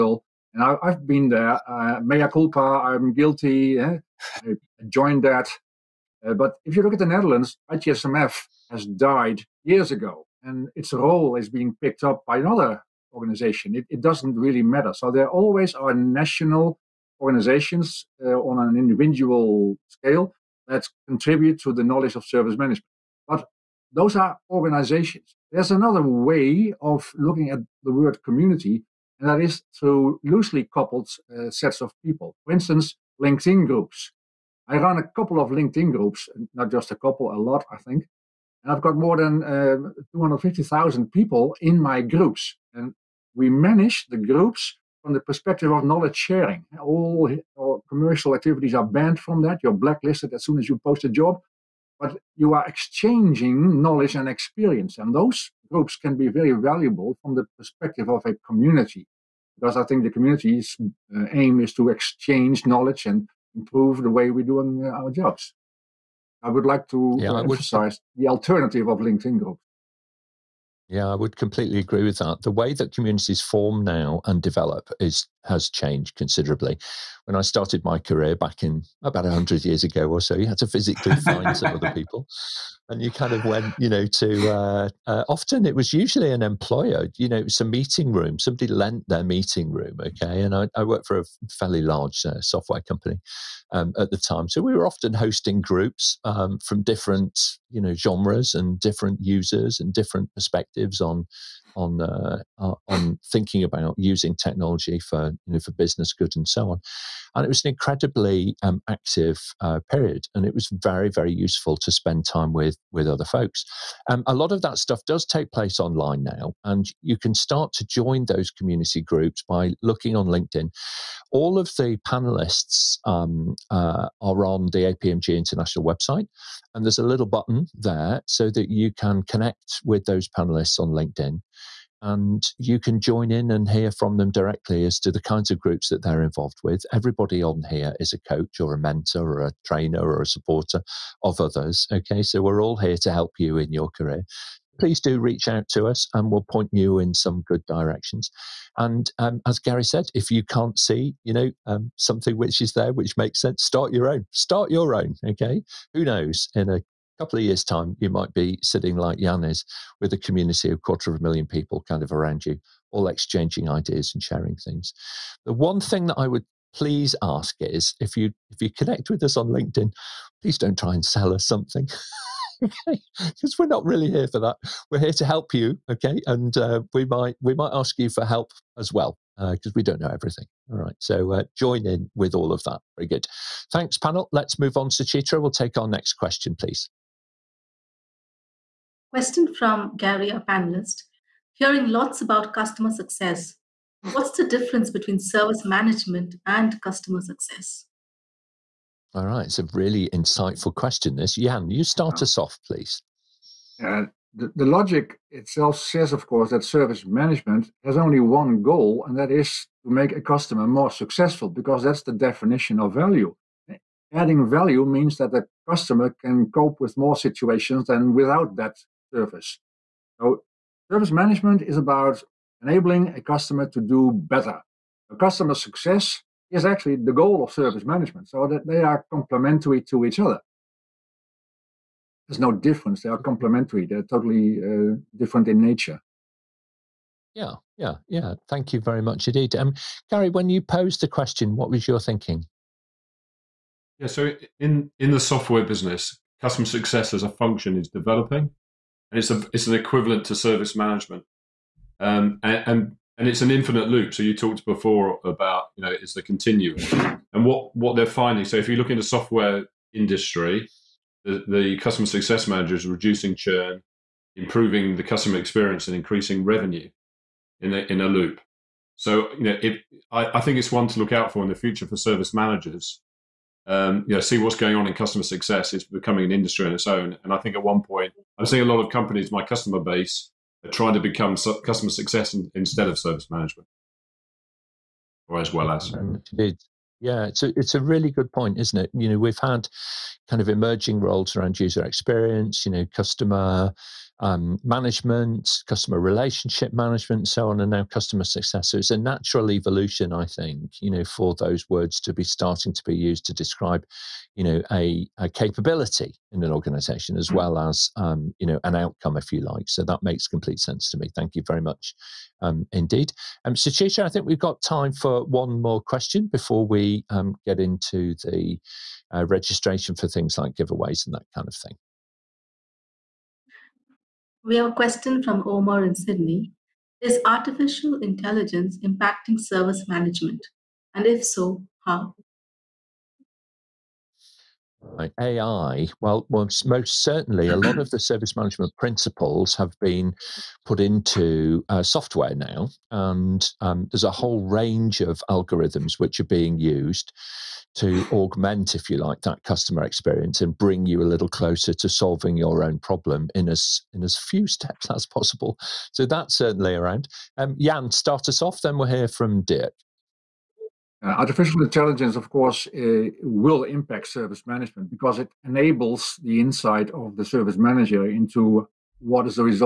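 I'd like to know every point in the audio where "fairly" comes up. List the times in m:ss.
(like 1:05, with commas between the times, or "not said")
1:31.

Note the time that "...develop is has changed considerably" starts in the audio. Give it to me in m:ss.
1:14.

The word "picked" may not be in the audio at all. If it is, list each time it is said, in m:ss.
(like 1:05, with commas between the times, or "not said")
0:11.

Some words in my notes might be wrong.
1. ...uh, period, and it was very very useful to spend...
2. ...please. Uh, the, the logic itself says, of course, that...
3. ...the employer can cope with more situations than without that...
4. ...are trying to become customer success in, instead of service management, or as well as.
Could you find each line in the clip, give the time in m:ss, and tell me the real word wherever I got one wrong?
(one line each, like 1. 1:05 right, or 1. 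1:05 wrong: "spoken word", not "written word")
1. 1:49 right
2. 3:22 right
3. 3:35 wrong: "customer", not "employer"
4. 4:40 right.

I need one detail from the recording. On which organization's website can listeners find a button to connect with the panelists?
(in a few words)
APMG International.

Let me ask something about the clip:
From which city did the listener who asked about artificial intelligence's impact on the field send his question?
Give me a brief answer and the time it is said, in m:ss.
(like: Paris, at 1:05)
Sydney, at 5:25.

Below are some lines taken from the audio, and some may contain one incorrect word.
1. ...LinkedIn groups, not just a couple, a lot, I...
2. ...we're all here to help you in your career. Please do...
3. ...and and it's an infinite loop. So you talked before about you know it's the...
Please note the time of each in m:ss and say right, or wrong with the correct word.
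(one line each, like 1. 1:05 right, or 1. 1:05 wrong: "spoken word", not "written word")
1. 0:35 right
2. 2:22 right
3. 4:12 right.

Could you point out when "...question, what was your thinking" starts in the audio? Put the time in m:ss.
4:01.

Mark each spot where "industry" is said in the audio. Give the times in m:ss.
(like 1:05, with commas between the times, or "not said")
4:19, 4:36.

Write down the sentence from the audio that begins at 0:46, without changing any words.
All, all commercial activities are banned from that.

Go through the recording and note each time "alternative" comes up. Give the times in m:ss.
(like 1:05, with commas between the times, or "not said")
1:08.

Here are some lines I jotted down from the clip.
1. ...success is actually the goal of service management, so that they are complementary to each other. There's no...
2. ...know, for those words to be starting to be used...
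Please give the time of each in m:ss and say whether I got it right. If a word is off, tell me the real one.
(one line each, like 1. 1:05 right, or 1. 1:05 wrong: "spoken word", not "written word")
1. 3:45 right
2. 5:00 right.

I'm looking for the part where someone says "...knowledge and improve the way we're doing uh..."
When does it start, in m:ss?
1:02.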